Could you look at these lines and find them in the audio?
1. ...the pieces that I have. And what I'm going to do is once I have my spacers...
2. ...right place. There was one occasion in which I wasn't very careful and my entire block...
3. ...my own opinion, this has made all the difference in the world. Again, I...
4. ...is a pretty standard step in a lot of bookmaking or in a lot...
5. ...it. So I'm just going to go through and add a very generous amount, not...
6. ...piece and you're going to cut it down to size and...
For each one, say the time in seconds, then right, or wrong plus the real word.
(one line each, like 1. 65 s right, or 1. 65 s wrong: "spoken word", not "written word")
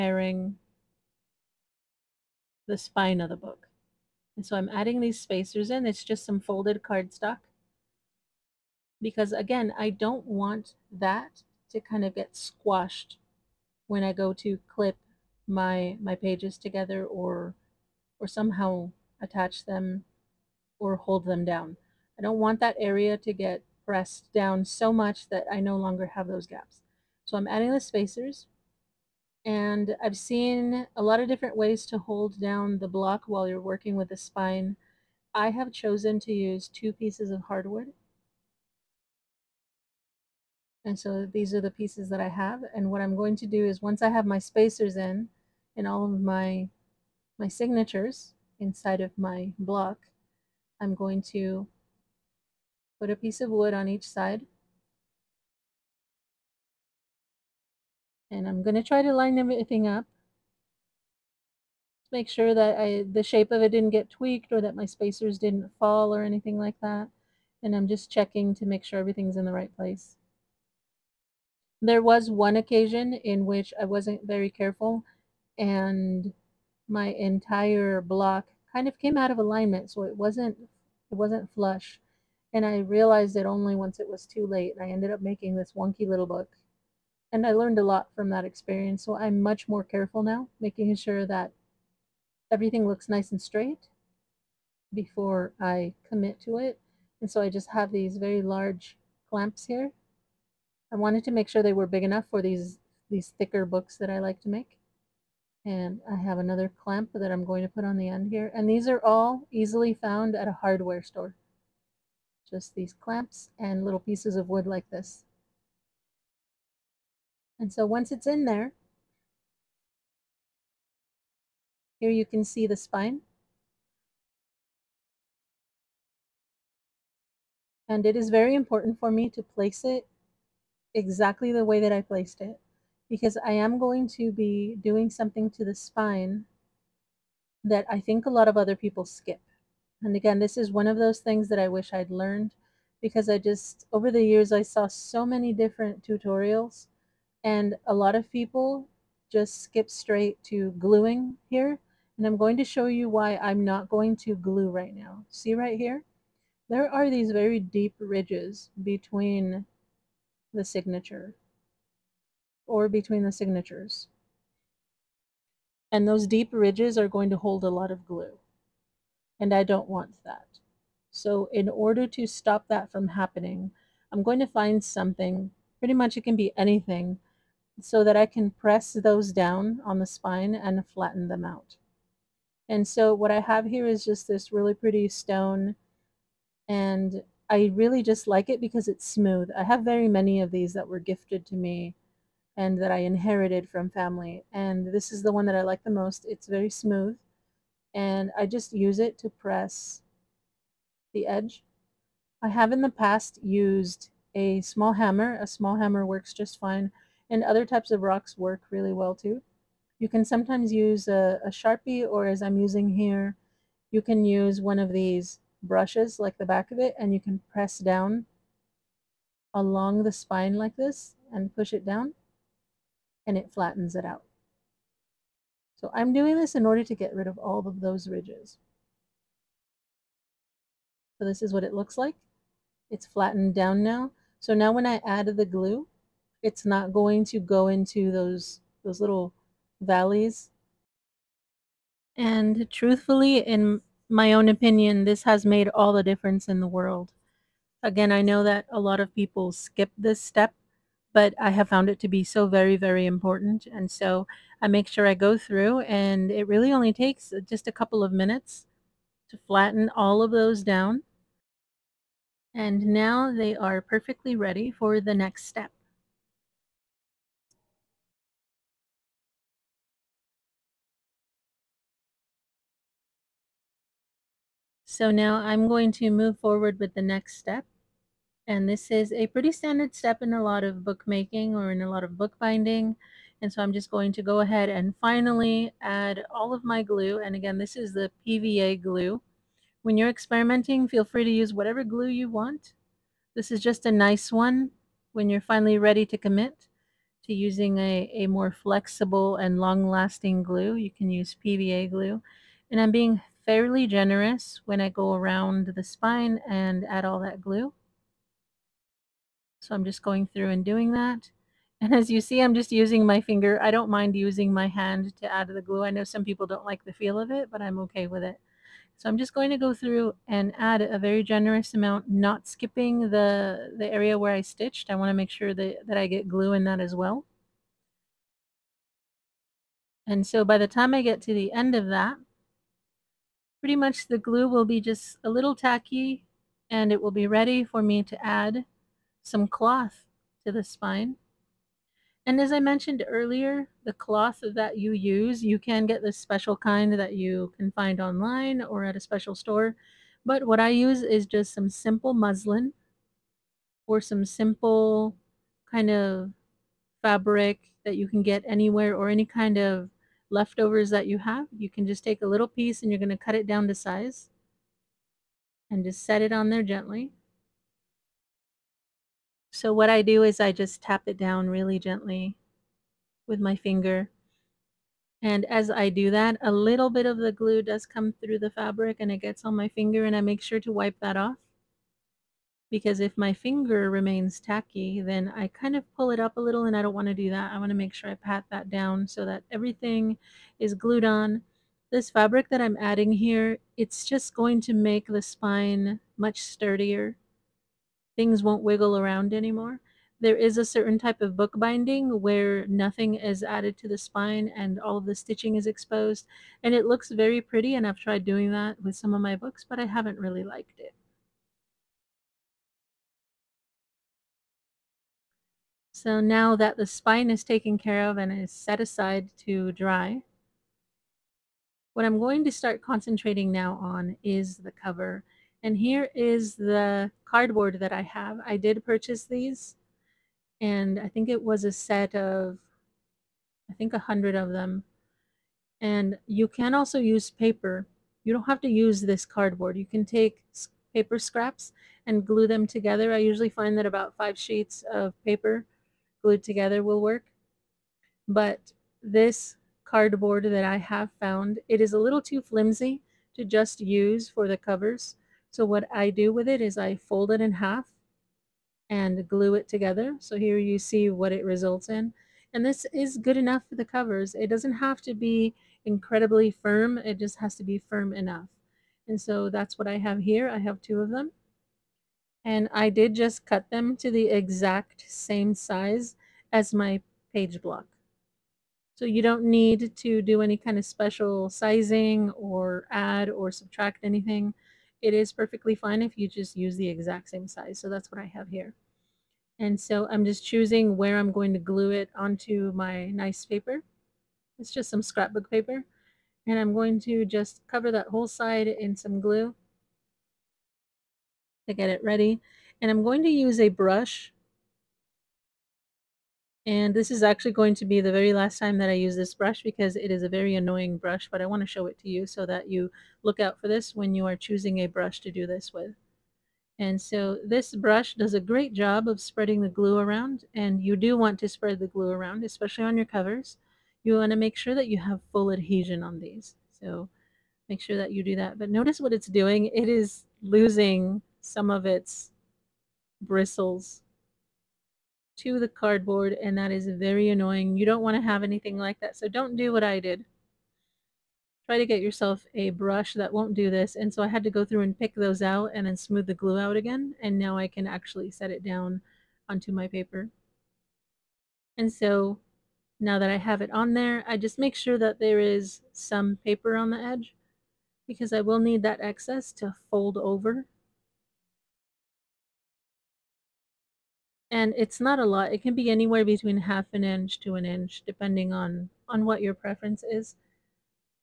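1. 41 s right
2. 69 s right
3. 244 s right
4. 278 s right
5. 318 s right
6. 362 s right.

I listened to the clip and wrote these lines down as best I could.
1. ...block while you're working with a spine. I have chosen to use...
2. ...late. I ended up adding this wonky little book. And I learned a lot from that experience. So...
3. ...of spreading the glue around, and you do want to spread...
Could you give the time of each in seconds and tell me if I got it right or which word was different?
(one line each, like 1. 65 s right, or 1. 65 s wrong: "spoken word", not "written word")
1. 32 s right
2. 84 s wrong: "making", not "adding"
3. 519 s right.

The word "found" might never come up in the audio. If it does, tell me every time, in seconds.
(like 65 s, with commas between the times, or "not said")
109 s, 251 s, 451 s.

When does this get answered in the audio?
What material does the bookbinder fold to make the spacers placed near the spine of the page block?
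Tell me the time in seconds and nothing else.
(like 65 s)
6 s.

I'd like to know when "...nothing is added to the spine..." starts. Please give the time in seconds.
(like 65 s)
402 s.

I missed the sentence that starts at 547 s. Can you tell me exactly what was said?
And now I can actually set it down onto my paper.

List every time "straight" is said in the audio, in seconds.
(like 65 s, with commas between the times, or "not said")
93 s, 149 s.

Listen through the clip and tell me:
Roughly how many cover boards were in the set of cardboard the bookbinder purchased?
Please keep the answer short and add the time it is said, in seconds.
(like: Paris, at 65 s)
100, at 433 s.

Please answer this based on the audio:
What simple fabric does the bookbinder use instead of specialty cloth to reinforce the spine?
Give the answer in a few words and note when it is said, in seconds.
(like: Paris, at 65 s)
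muslin, at 352 s.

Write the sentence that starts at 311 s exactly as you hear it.
And as you see, I'm just using my finger.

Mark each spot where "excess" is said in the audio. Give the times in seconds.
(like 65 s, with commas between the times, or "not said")
559 s.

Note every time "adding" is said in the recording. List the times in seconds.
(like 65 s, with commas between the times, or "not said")
4 s, 27 s, 392 s.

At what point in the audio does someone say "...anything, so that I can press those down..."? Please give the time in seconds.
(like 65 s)
176 s.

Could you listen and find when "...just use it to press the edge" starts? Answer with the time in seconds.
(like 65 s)
198 s.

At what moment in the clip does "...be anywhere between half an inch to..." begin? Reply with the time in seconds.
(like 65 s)
565 s.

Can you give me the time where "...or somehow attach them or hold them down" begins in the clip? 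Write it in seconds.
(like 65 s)
18 s.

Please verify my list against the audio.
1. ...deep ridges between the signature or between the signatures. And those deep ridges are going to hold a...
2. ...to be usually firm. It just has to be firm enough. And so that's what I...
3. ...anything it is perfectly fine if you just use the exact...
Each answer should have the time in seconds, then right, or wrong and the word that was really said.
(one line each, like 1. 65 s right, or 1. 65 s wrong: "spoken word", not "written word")
1. 157 s right
2. 465 s wrong: "incredibly", not "usually"
3. 484 s right.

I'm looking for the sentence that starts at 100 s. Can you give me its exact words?
I wanted to make sure they were big enough for these, these thicker books that I like to make.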